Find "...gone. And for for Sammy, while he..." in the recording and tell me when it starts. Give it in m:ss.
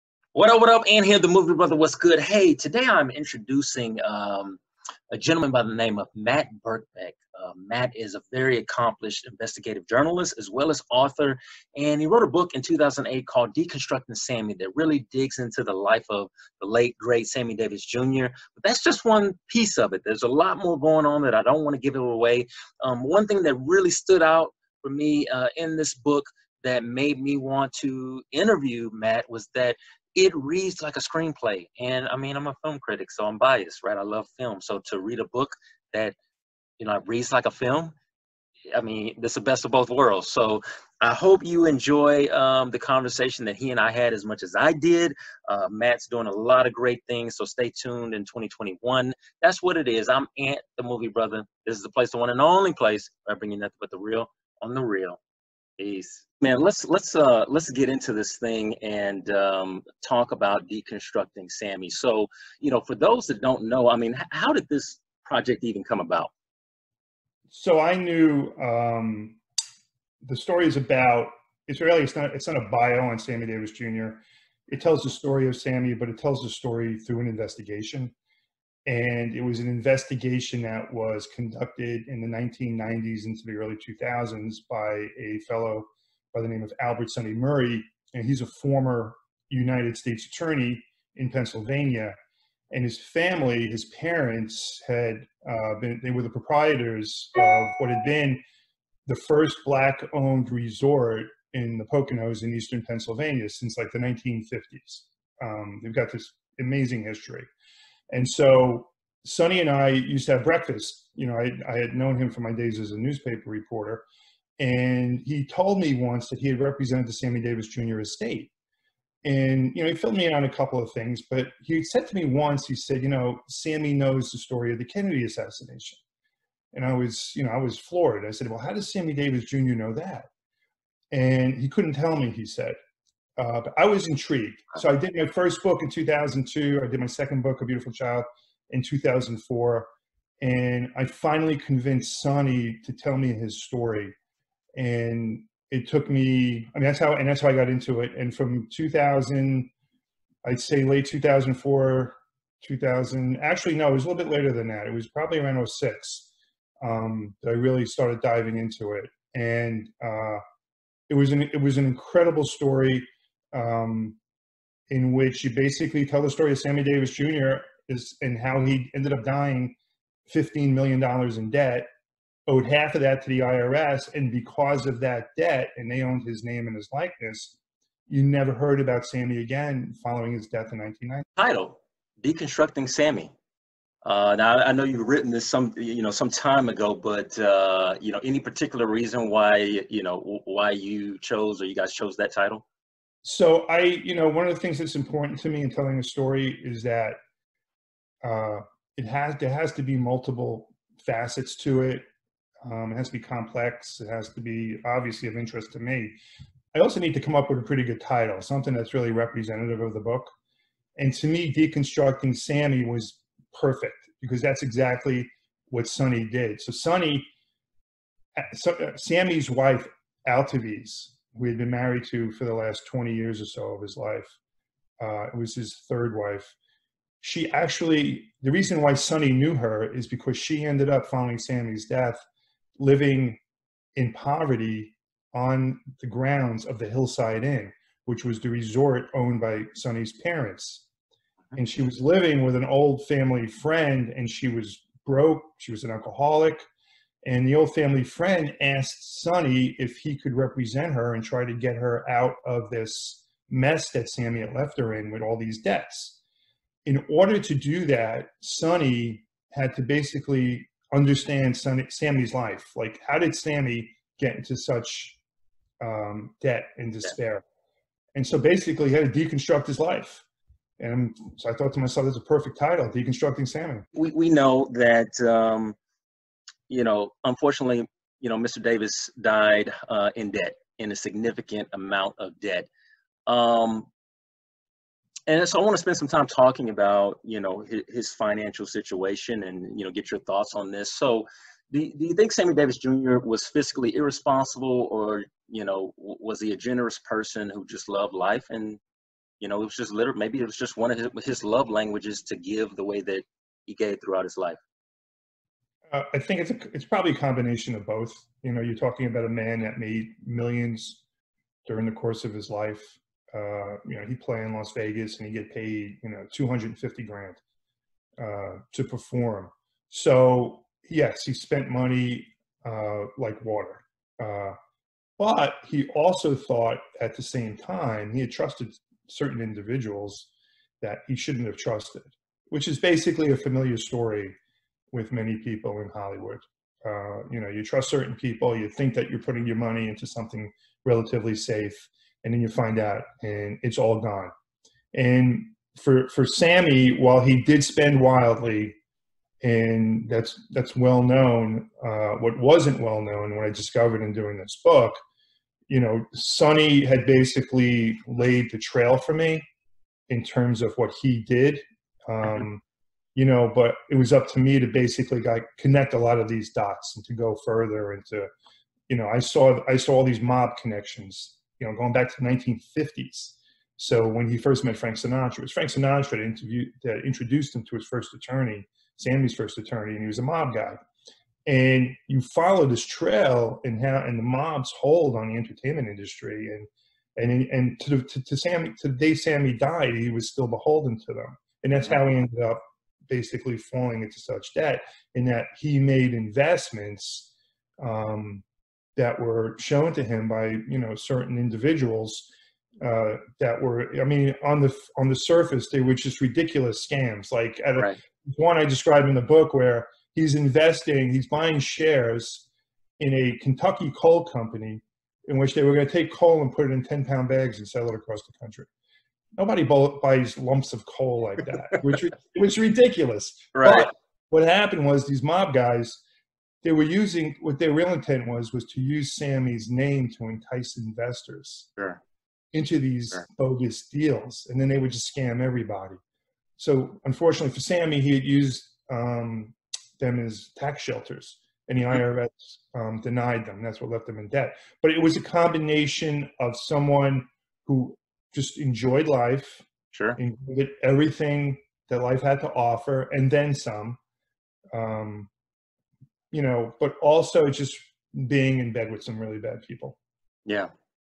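5:43.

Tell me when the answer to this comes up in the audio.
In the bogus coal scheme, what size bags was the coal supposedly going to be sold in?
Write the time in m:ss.
6:56.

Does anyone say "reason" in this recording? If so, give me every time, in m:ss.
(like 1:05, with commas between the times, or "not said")
3:08, 3:48.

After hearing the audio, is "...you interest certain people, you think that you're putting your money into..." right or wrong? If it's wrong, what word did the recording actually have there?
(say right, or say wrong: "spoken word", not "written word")
wrong: "trust", not "interest".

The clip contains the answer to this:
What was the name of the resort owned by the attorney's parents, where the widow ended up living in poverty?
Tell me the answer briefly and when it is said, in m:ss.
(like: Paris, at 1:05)
Hillside Inn, at 3:56.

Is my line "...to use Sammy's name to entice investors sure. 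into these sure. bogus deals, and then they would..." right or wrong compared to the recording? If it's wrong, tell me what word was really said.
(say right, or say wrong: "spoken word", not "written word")
right.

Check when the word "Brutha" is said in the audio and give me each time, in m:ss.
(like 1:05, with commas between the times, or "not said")
0:01, 0:51.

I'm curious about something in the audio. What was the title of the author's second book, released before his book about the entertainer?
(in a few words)
A Beautiful Child.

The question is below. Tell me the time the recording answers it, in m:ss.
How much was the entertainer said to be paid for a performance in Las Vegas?
5:16.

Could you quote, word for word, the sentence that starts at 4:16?
In order to do that, Sonny had to basically understand Sonny, Sammy's life.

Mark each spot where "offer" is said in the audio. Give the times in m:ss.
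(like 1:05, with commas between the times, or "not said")
7:32.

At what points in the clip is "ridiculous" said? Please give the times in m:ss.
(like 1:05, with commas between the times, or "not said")
6:46, 7:02.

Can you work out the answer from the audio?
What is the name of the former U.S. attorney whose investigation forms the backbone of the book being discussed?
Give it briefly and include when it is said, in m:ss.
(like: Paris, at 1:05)
Albert Sonny Murray, at 1:26.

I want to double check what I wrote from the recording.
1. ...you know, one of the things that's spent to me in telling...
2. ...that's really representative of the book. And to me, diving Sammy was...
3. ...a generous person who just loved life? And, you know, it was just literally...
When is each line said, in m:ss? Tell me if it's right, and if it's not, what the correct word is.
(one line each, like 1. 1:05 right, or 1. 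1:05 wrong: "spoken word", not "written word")
1. 3:13 wrong: "important", not "spent"
2. 3:28 wrong: "deconstructing", not "diving"
3. 4:56 right.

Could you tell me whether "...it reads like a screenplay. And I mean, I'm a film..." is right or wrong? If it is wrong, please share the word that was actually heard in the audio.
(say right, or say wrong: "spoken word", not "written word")
right.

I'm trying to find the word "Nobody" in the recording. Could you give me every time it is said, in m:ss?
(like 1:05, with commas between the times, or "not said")
6:59.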